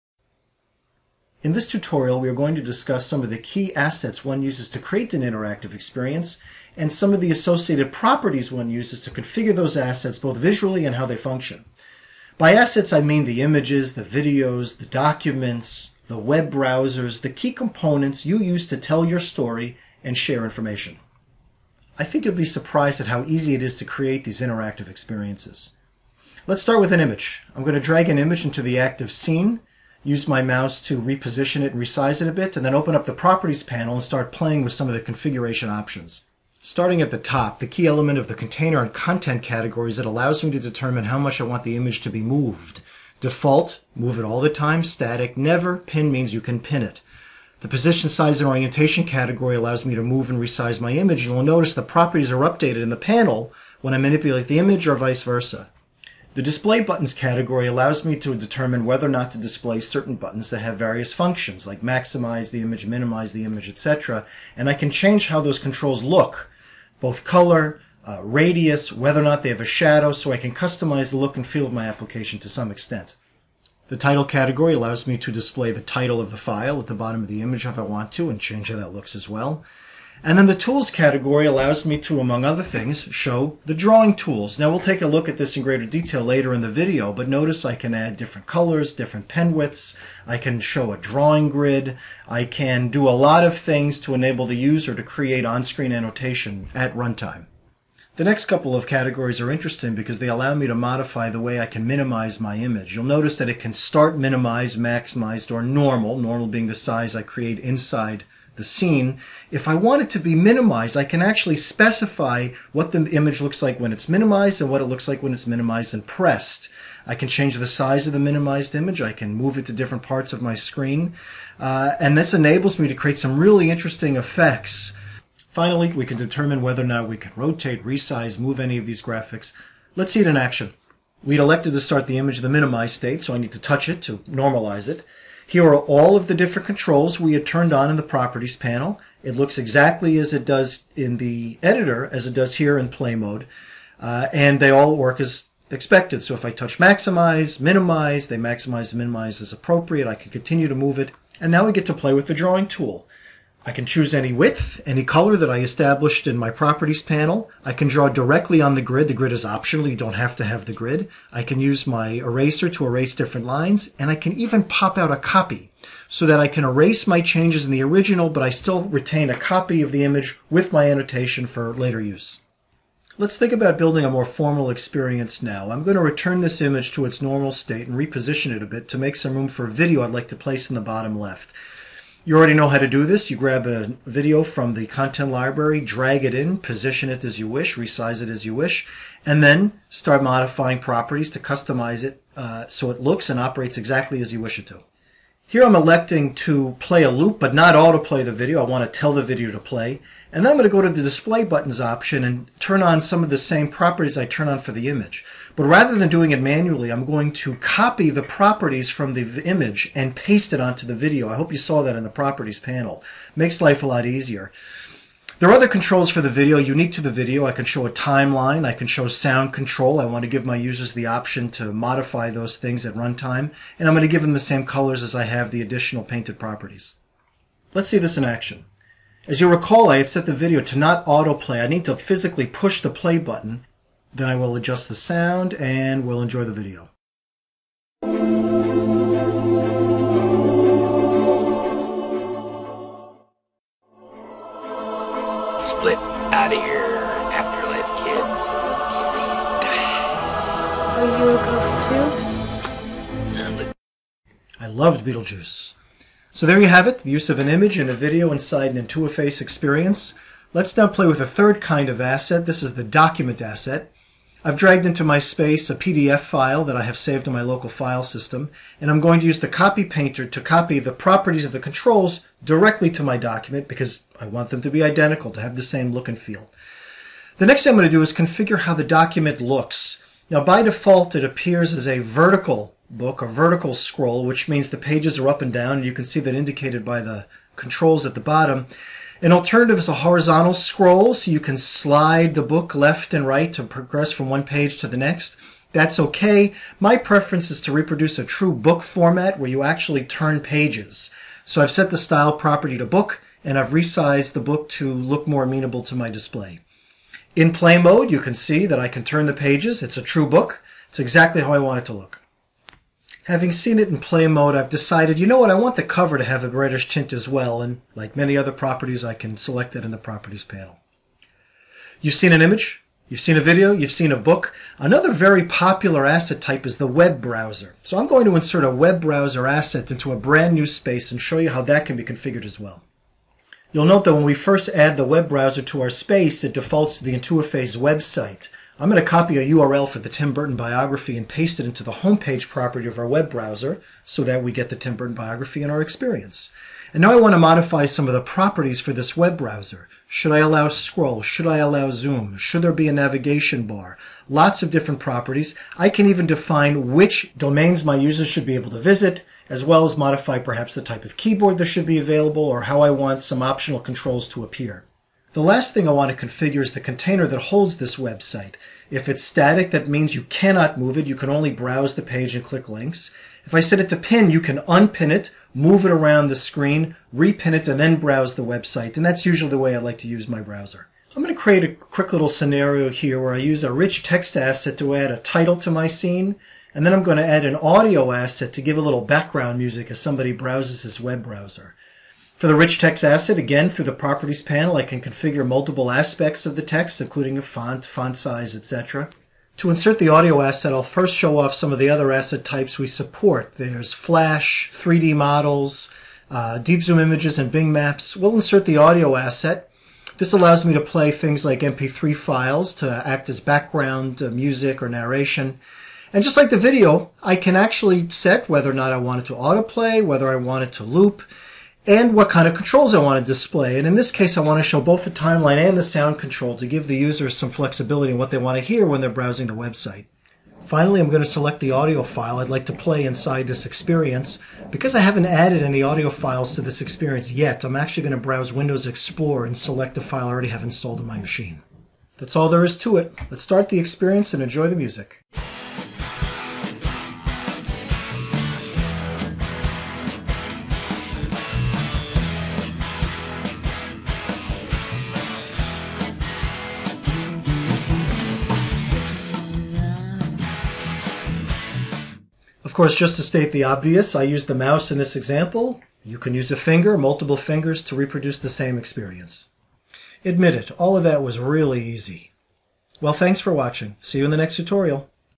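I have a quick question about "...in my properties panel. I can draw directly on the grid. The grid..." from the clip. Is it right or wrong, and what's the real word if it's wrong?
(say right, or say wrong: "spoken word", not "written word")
right.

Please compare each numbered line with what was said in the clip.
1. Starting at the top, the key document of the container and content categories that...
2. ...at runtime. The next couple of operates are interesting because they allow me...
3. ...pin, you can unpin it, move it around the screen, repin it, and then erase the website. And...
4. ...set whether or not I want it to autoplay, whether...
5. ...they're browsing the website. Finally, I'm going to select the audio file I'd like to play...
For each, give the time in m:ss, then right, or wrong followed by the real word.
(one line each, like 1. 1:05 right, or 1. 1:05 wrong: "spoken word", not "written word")
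1. 0:36 wrong: "element", not "document"
2. 1:36 wrong: "categories", not "operates"
3. 6:13 wrong: "browse", not "erase"
4. 6:58 right
5. 7:09 right.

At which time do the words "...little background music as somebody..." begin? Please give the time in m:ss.
6:28.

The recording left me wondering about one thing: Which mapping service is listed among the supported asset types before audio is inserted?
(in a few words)
Bing Maps.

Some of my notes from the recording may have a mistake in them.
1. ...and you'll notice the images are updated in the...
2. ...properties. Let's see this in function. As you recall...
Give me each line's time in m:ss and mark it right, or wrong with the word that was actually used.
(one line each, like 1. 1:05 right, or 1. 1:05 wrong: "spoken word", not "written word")
1. 0:51 wrong: "properties", not "images"
2. 3:46 wrong: "action", not "function".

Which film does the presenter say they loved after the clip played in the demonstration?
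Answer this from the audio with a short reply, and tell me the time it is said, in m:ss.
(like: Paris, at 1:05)
Beetlejuice, at 4:15.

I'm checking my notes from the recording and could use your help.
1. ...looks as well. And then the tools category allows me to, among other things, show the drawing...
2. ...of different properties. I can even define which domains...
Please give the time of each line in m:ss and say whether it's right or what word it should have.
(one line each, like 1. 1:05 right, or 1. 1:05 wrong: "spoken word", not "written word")
1. 1:18 right
2. 5:54 right.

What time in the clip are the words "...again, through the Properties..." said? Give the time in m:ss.
6:33.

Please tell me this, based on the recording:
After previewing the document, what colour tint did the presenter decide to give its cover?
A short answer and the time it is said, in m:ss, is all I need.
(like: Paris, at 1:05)
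Reddish, at 5:16.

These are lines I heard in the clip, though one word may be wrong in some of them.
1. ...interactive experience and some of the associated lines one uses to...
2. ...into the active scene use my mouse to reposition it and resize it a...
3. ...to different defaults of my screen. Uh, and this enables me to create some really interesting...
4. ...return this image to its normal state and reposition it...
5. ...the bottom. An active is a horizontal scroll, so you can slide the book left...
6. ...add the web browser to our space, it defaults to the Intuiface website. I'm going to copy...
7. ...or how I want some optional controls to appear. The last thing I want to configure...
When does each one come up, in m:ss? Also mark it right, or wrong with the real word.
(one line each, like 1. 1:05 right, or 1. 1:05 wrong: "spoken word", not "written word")
1. 0:05 wrong: "properties", not "lines"
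2. 0:28 right
3. 1:59 wrong: "parts", not "defaults"
4. 2:56 right
5. 4:48 wrong: "alternative", not "active"
6. 5:34 right
7. 6:02 right.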